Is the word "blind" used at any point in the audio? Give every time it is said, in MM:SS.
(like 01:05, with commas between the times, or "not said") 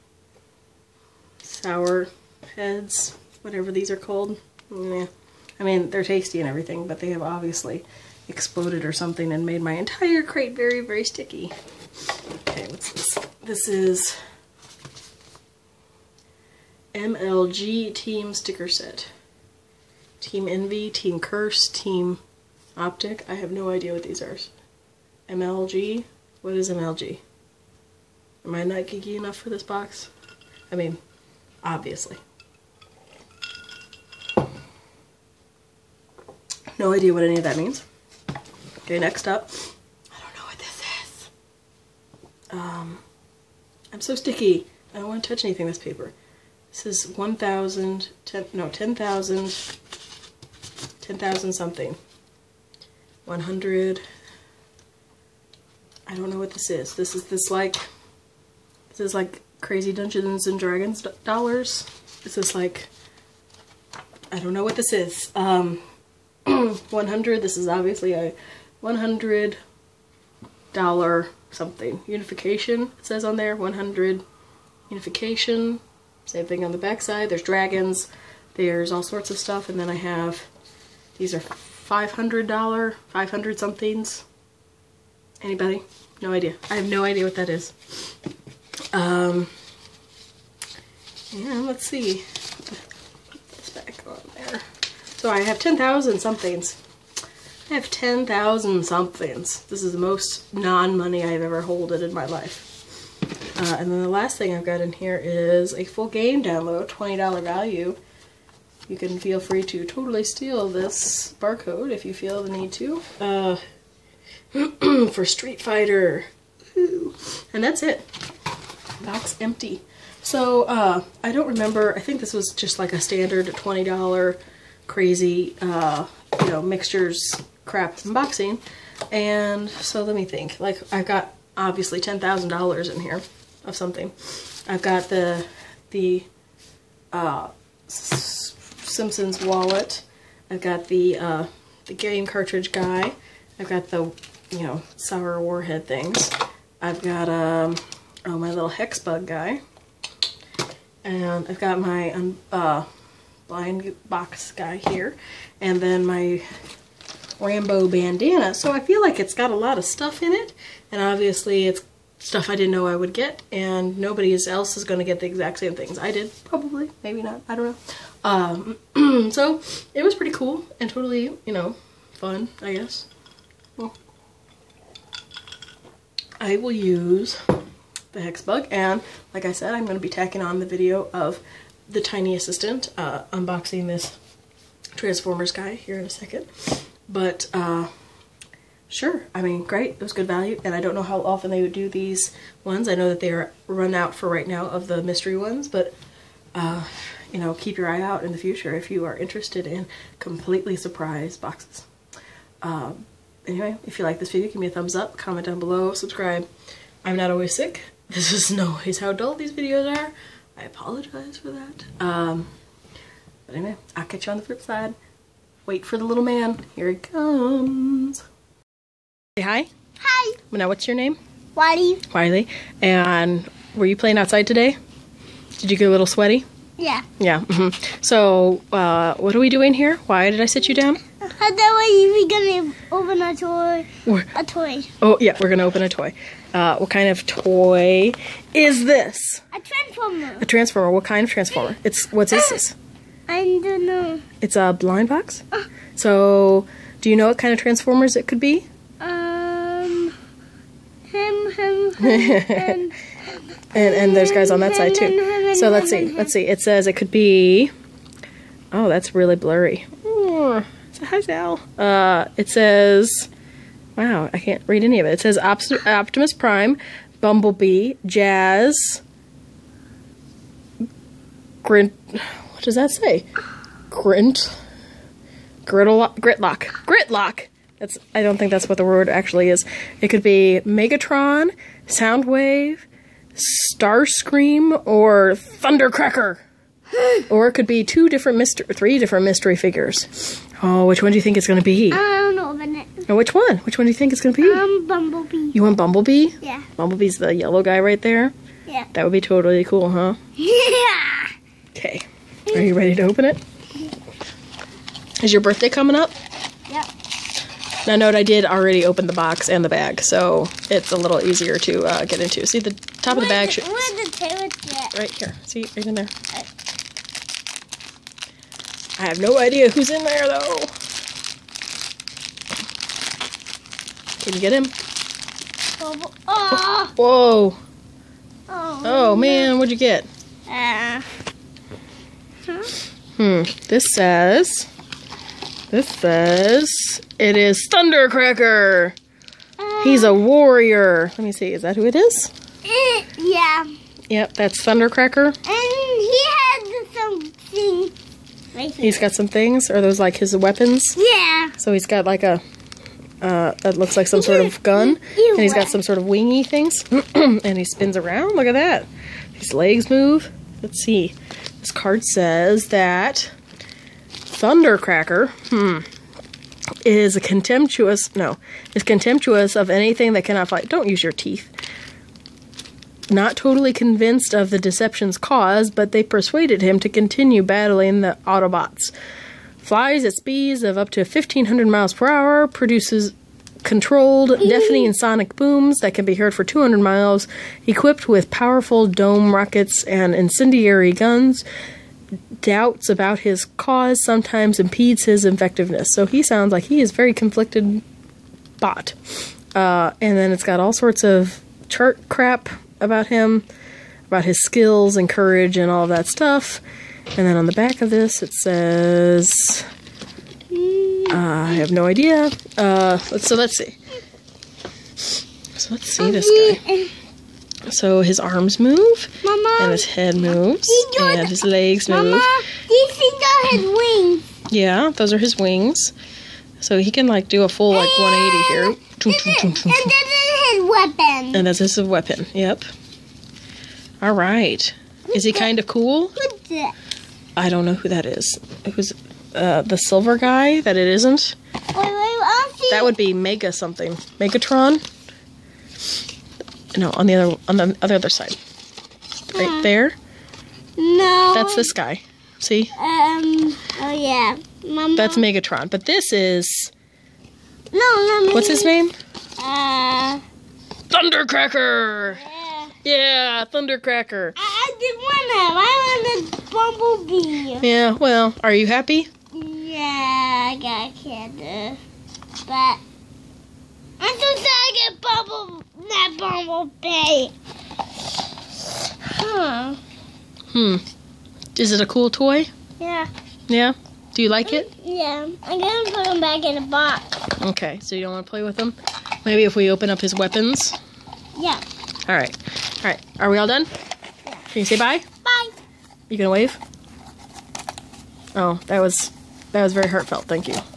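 02:33, 04:04.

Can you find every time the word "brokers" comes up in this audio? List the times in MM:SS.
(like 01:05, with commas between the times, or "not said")
not said.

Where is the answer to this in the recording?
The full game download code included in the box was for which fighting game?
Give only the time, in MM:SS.
01:55.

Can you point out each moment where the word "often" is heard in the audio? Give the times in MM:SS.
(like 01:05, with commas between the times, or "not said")
03:11.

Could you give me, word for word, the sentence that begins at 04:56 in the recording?
Bumblebee's the yellow guy right there?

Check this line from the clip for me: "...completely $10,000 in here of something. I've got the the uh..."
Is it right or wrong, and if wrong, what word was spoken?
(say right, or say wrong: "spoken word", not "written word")
wrong: "obviously", not "completely".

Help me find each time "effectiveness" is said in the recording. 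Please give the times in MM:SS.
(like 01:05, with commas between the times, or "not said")
06:35.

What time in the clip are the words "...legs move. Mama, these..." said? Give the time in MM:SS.
07:01.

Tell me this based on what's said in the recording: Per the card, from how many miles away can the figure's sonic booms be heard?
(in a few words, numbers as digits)
200.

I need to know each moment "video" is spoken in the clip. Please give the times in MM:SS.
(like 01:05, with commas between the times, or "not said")
03:00, 03:24, 03:29.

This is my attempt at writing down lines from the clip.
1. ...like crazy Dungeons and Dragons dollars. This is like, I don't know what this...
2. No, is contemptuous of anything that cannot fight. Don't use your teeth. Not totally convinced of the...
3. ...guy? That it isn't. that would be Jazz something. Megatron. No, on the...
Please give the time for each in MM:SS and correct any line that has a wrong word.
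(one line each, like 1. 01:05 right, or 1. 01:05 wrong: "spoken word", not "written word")
1. 00:59 right
2. 06:08 right
3. 07:20 wrong: "Mega", not "Jazz".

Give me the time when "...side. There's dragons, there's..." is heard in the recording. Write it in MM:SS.
01:17.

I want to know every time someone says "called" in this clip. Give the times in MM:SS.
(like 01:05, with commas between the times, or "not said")
00:03.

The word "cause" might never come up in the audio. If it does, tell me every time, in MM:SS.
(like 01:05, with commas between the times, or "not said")
06:15, 06:33.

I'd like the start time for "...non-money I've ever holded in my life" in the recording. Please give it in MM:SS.
01:40.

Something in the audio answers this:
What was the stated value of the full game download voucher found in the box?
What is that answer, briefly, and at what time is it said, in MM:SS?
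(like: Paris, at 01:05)
$20, at 01:46.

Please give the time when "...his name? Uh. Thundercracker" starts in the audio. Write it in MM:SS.
07:38.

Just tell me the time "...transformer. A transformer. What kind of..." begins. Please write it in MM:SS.
03:59.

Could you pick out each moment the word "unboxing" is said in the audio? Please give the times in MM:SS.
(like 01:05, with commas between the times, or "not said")
02:07, 03:03.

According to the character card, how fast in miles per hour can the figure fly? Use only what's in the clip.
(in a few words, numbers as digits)
1500.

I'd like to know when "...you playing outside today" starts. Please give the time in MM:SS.
03:43.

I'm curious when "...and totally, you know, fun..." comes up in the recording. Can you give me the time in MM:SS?
02:50.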